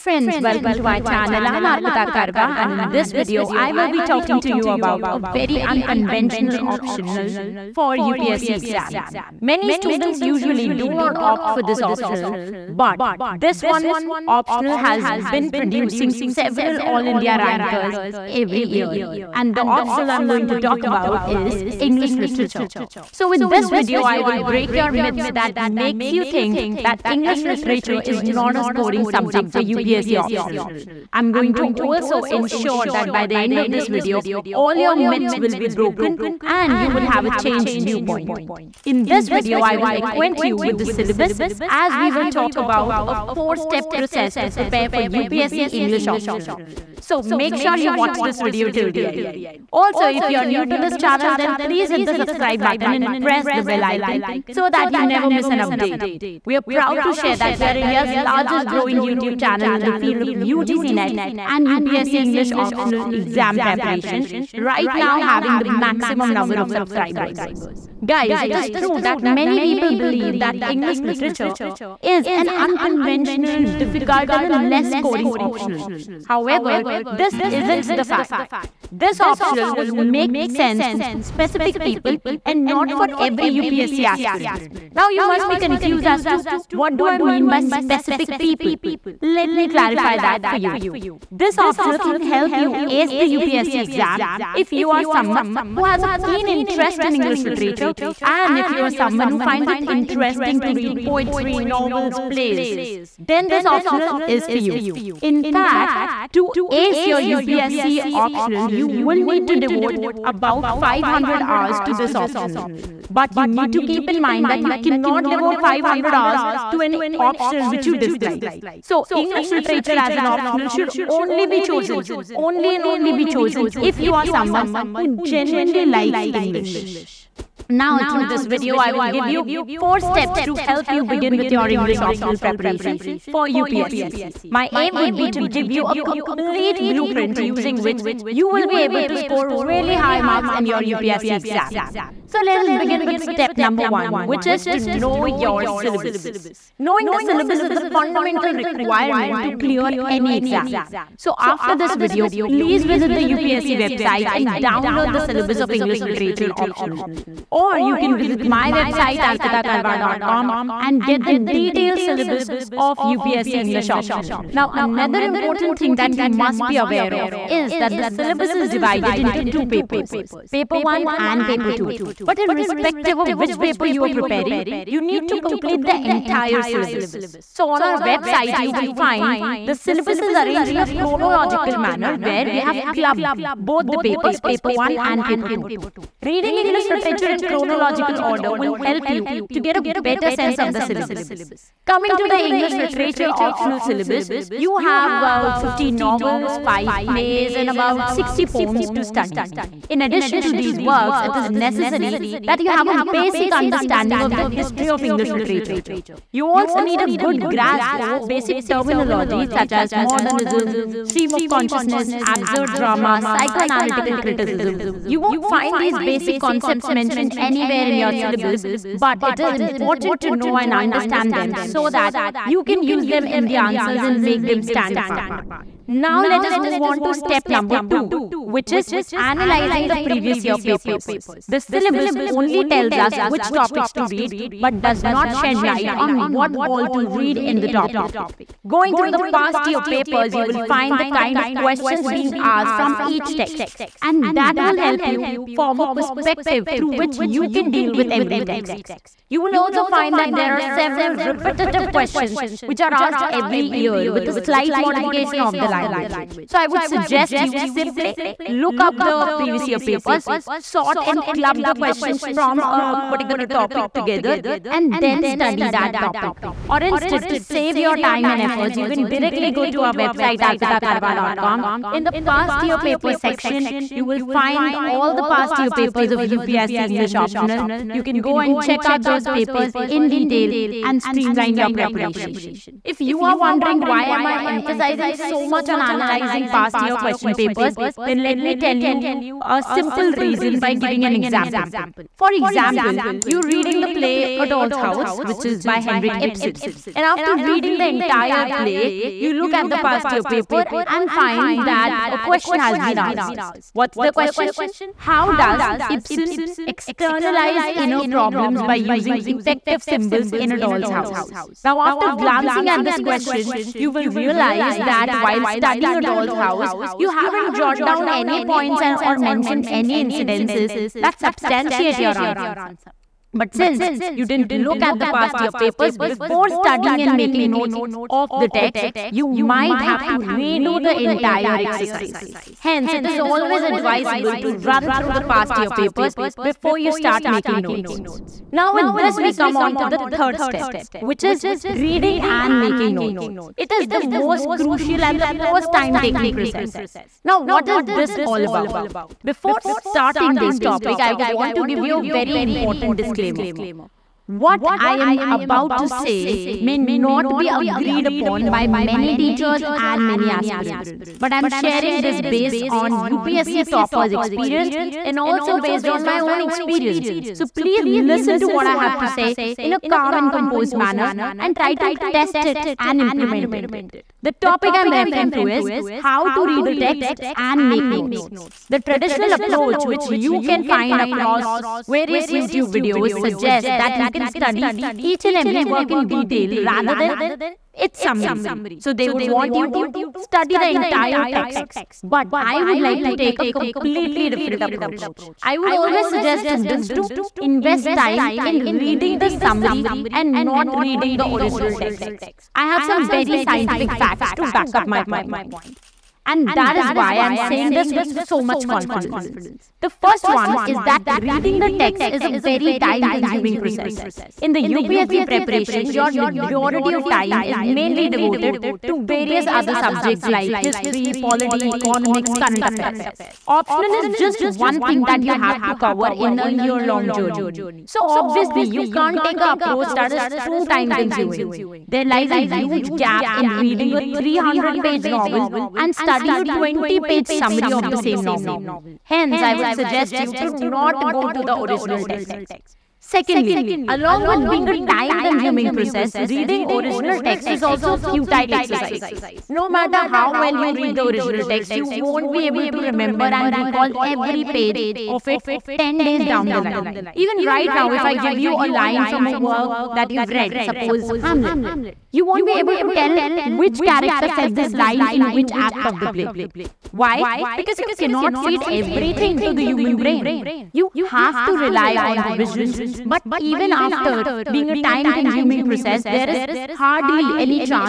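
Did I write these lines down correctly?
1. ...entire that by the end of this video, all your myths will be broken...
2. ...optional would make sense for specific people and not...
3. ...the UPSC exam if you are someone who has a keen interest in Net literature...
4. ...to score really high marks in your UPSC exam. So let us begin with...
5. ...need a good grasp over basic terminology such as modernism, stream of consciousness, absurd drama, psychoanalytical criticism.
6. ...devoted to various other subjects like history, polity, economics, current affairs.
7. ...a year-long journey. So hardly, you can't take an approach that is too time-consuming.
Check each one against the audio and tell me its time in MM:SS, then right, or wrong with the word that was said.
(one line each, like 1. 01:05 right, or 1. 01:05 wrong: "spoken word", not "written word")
1. 00:32 wrong: "ensure", not "entire"
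2. 01:19 right
3. 01:33 wrong: "English", not "Net"
4. 02:19 right
5. 03:26 right
6. 06:58 right
7. 07:06 wrong: "obviously", not "hardly".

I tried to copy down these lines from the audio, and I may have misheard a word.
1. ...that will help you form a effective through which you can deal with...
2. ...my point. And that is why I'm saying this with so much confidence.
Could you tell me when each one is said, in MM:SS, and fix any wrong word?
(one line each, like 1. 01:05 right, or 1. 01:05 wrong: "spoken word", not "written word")
1. 04:04 wrong: "perspective", not "effective"
2. 06:44 right.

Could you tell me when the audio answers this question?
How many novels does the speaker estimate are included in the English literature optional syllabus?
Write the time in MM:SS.
03:15.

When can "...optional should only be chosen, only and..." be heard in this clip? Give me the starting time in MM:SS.
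02:00.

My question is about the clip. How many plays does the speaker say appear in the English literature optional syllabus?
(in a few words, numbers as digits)
5.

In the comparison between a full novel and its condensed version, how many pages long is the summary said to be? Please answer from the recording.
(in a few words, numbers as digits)
20.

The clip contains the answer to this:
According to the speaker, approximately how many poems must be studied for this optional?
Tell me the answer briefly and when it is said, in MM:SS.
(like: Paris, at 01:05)
60, at 03:18.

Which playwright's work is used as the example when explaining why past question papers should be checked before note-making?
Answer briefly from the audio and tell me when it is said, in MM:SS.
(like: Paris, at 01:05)
Henrik Ibsen, at 04:55.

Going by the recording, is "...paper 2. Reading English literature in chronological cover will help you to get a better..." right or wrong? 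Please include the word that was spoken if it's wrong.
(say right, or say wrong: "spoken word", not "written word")
wrong: "order", not "cover".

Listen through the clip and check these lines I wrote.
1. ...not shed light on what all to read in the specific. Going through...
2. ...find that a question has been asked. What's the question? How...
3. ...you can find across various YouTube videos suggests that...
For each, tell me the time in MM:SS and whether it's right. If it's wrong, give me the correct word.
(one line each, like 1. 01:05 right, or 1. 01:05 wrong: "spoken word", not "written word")
1. 03:55 wrong: "topic", not "specific"
2. 05:01 right
3. 06:20 right.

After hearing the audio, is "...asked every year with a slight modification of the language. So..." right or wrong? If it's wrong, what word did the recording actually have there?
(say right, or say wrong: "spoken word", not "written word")
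right.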